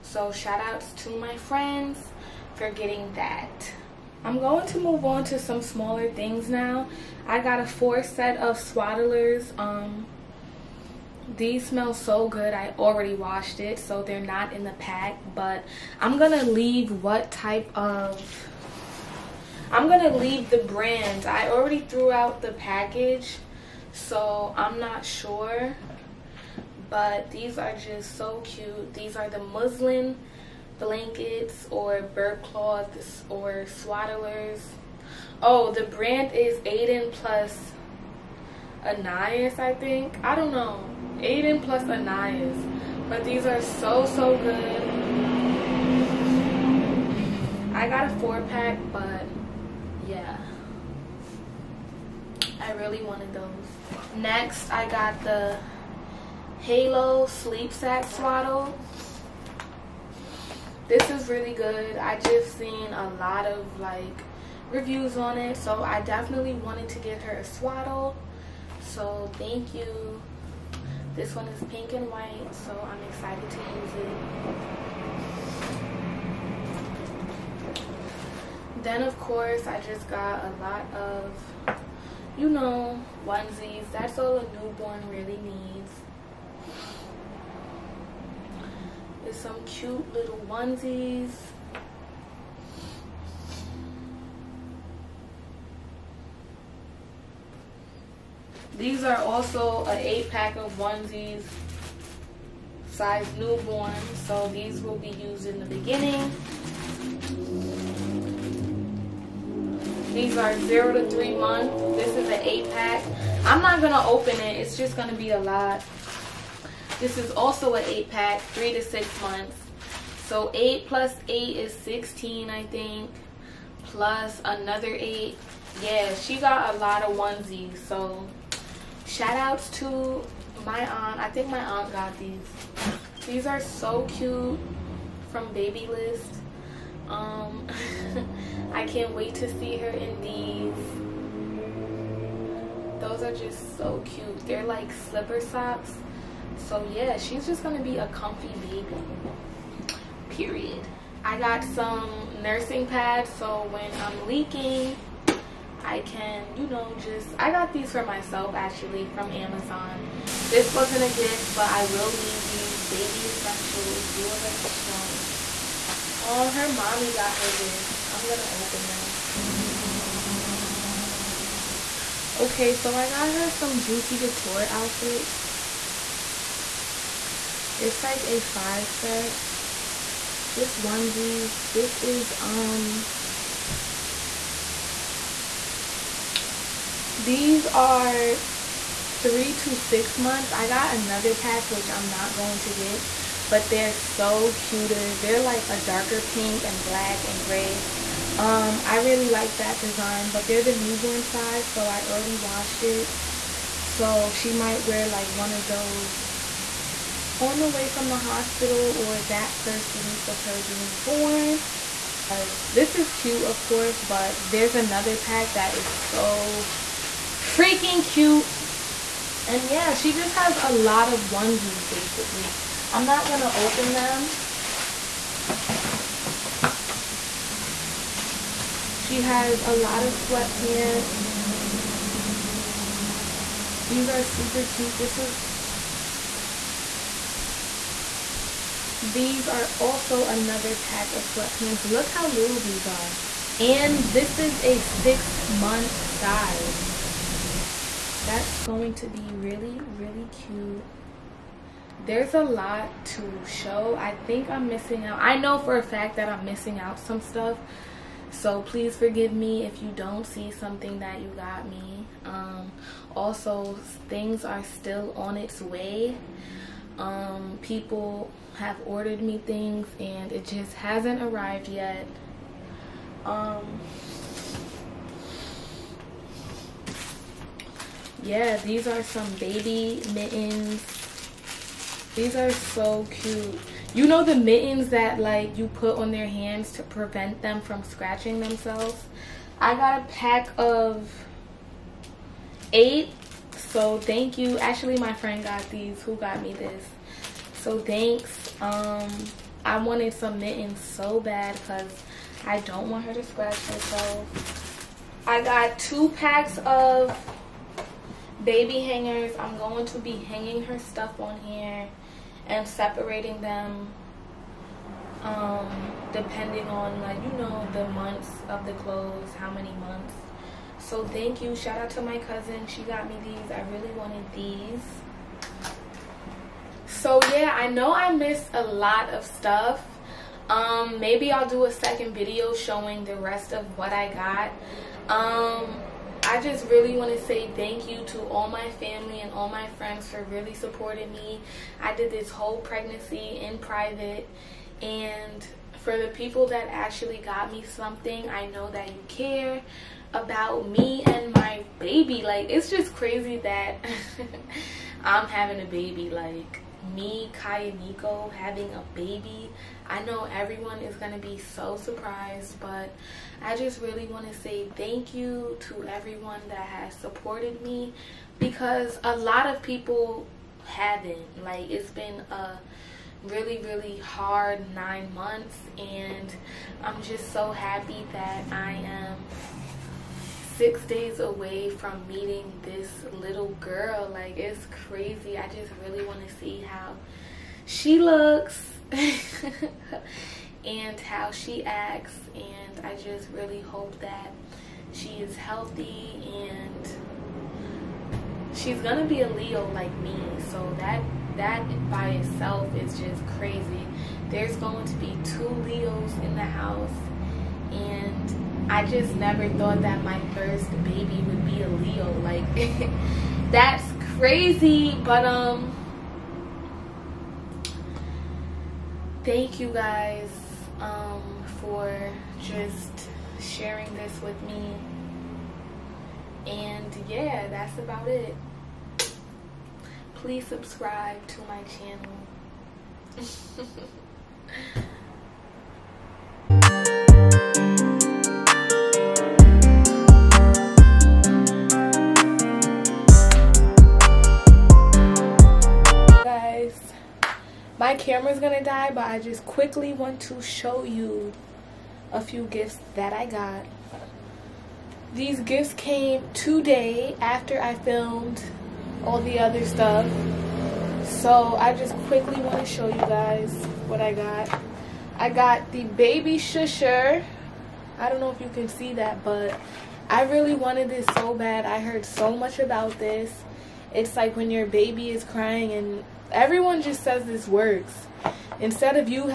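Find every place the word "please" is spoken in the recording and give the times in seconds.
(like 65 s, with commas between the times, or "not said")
258 s, 430 s.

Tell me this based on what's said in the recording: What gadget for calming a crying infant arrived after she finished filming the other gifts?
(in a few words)
baby shusher.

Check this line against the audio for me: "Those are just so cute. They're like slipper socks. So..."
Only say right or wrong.
right.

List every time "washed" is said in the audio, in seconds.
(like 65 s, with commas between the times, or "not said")
13 s, 202 s.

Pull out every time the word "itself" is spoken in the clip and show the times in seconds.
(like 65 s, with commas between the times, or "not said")
402 s.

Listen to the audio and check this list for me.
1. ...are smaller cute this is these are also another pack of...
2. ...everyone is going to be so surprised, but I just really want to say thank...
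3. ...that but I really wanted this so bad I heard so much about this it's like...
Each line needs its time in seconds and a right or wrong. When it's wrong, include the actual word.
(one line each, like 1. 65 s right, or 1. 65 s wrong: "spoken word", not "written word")
1. 234 s wrong: "super", not "smaller"
2. 360 s right
3. 468 s right.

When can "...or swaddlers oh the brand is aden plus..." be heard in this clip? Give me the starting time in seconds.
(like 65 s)
33 s.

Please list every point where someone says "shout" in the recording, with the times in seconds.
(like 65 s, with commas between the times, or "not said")
0 s, 129 s, 321 s.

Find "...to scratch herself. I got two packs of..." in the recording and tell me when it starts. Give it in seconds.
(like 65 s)
303 s.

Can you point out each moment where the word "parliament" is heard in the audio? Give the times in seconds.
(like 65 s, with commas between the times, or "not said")
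not said.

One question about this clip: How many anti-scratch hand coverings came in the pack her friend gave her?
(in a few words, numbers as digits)
8.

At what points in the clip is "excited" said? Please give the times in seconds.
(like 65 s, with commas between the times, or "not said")
73 s.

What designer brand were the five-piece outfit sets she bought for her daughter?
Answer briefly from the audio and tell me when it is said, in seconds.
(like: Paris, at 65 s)
Juicy Couture, at 173 s.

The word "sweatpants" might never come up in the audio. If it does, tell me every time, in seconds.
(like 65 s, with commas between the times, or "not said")
230 s, 241 s.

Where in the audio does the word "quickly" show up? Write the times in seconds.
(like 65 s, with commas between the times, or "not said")
449 s, 462 s.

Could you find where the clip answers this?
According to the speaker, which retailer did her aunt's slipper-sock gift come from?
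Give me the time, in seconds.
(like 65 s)
135 s.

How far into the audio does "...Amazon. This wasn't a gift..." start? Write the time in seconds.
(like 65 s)
159 s.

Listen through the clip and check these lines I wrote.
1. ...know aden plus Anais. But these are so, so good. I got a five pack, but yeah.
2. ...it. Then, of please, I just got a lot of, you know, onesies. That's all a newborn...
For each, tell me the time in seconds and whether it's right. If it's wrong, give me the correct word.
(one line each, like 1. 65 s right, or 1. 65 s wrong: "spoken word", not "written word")
1. 40 s wrong: "four", not "five"
2. 78 s wrong: "course", not "please".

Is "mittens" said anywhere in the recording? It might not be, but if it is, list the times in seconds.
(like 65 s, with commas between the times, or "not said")
280 s, 284 s, 300 s.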